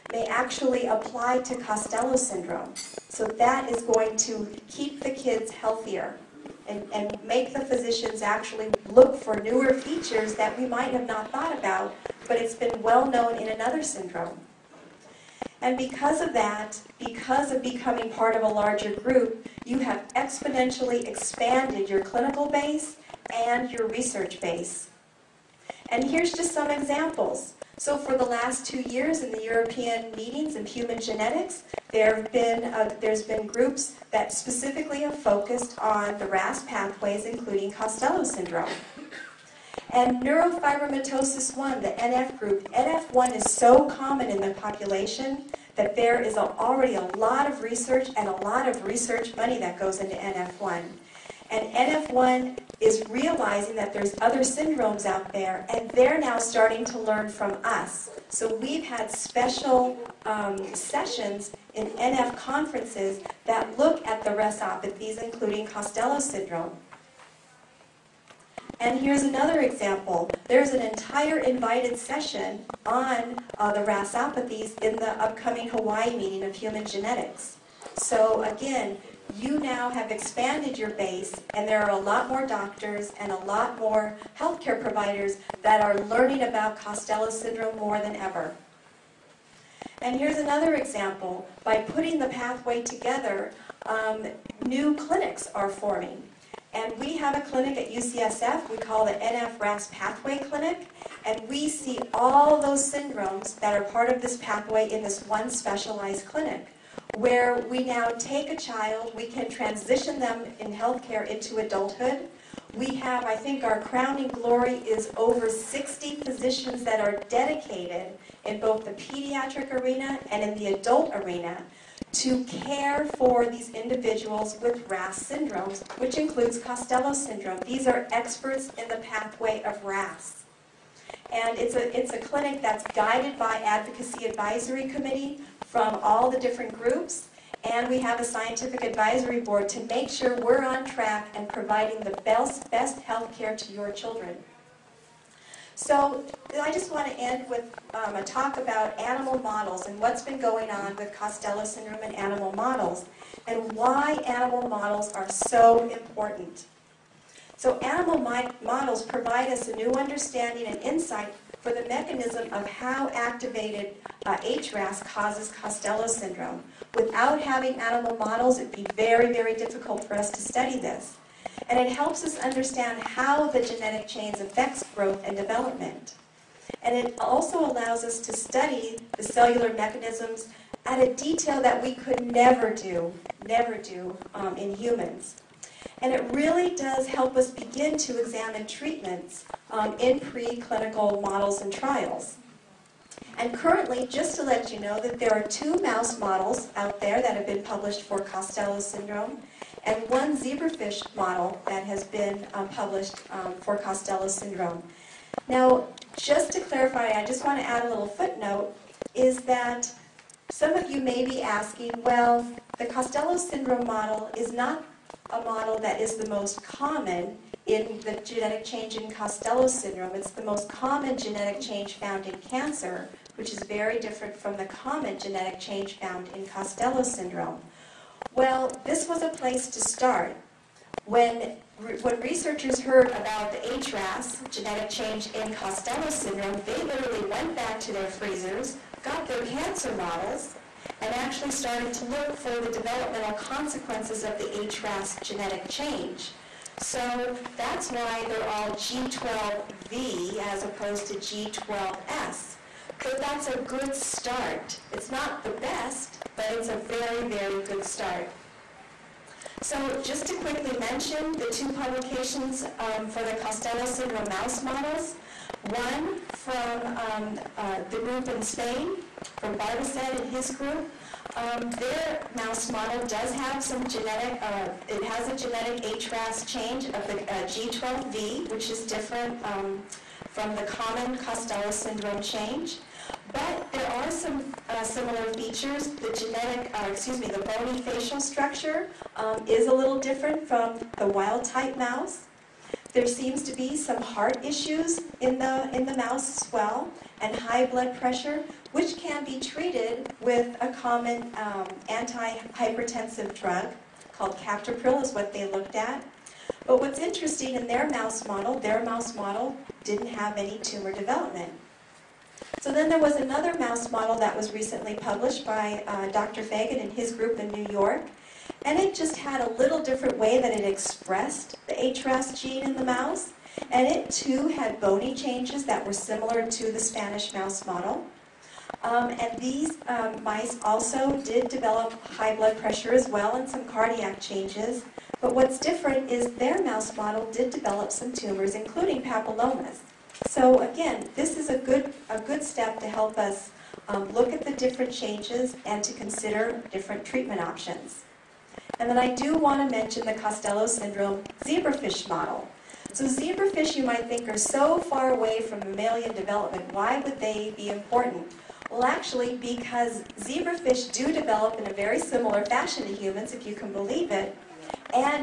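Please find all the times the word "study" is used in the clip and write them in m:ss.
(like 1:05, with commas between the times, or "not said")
2:50, 2:58.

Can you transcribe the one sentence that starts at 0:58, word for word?
So we've had special um, sessions in NF conferences that look at the RASopathies, including Costello syndrome.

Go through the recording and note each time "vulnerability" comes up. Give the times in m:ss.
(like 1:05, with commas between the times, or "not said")
not said.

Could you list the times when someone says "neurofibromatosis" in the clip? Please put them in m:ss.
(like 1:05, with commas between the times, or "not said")
0:40.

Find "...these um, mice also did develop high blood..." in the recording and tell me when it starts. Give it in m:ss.
5:29.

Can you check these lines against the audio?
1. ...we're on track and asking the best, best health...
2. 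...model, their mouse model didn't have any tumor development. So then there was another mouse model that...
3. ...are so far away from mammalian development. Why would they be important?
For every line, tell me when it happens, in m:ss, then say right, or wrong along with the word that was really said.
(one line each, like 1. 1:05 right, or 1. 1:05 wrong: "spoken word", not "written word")
1. 2:20 wrong: "providing", not "asking"
2. 5:08 right
3. 5:54 right.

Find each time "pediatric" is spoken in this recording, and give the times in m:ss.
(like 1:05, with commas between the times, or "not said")
1:58.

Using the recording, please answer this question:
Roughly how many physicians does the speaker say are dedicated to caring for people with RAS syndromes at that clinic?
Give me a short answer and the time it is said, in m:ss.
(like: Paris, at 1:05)
over 60, at 1:55.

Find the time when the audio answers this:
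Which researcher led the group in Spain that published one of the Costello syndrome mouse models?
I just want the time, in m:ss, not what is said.
4:29.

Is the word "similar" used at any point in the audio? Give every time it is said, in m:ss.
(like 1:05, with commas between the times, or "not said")
4:44, 5:25, 6:01.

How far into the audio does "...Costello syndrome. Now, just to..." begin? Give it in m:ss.
3:23.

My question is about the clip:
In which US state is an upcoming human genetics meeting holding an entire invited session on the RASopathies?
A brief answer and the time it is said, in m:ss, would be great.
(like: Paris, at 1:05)
Hawaii, at 1:15.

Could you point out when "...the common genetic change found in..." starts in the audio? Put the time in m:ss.
3:44.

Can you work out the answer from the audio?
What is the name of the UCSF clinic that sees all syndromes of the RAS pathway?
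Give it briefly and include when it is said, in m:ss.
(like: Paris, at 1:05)
NF-RAS Pathway Clinic, at 1:39.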